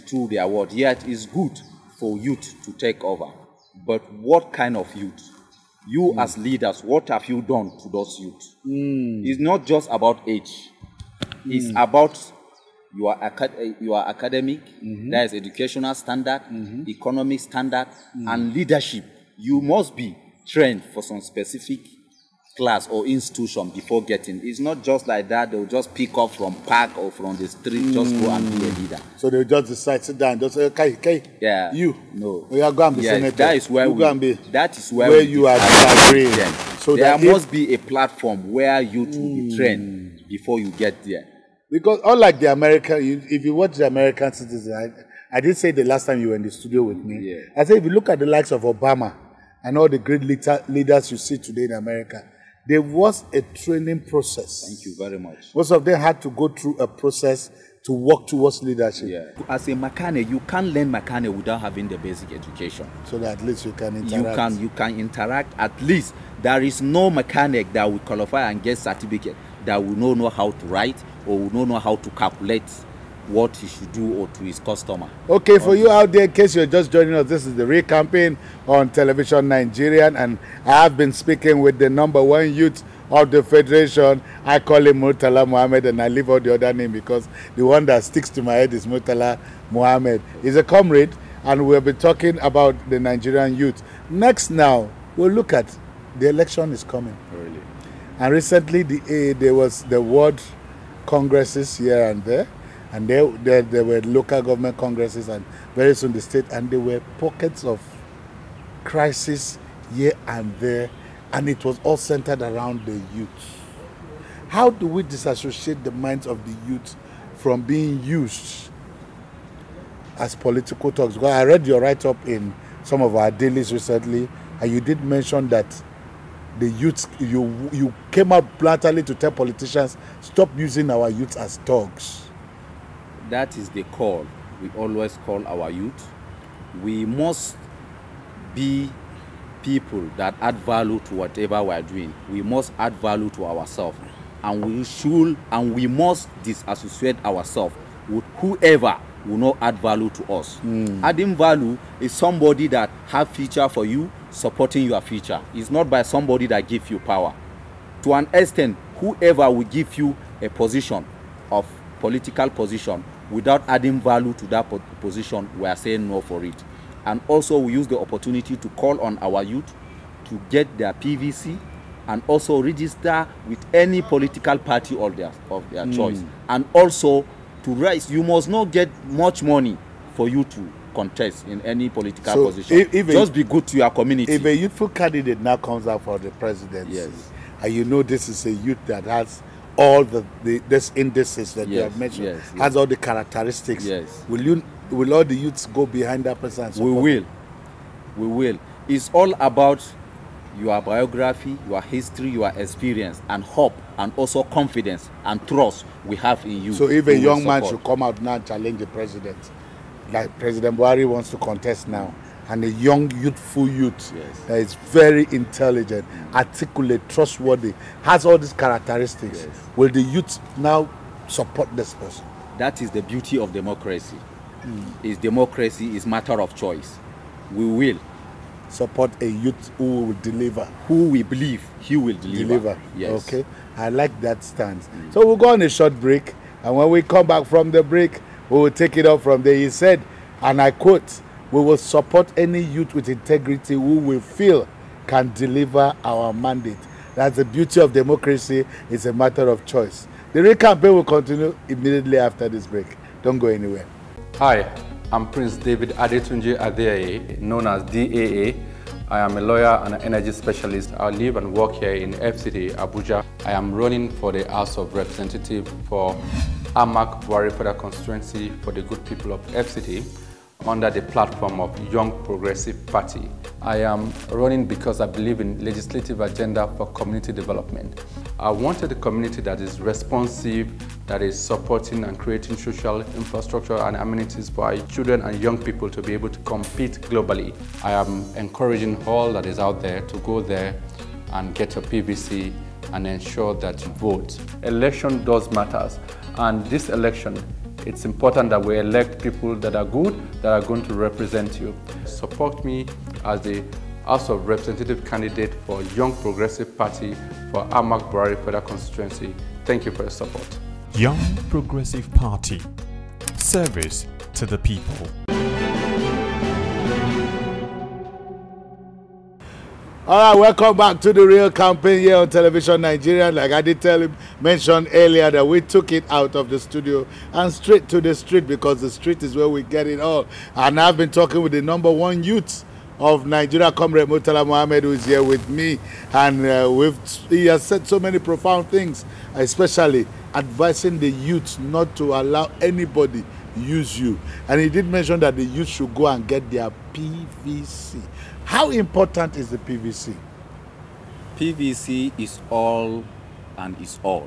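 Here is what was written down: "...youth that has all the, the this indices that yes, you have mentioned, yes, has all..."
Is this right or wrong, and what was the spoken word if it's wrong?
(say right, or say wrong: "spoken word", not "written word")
right.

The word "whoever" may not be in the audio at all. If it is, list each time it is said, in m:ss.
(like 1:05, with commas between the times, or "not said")
2:28, 2:38.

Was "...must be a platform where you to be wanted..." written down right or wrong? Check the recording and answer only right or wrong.
wrong.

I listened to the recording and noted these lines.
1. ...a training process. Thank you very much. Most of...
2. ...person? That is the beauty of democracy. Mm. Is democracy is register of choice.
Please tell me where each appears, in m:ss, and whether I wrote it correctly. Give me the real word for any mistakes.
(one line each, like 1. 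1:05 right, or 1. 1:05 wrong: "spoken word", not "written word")
1. 0:53 right
2. 3:41 wrong: "matter", not "register".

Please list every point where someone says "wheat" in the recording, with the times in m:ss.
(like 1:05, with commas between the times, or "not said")
not said.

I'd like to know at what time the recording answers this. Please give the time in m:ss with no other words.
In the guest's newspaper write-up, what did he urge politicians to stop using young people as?
2:11.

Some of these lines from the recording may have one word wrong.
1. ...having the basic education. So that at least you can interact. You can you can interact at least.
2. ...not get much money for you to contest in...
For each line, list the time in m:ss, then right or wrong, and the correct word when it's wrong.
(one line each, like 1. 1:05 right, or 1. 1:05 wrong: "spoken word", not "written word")
1. 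1:01 right
2. 2:58 right.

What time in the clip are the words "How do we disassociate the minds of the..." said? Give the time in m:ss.
1:54.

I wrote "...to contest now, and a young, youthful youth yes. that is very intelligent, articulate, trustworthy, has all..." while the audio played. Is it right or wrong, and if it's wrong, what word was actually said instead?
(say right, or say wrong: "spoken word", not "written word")
right.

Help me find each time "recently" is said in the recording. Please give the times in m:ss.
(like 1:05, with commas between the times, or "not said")
1:38, 2:03.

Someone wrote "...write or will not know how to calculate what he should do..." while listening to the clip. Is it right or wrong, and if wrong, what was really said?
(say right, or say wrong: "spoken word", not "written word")
right.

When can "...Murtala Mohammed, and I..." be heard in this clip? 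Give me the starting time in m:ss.
1:25.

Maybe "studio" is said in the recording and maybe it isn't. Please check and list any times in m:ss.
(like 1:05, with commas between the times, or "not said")
0:46, 5:26.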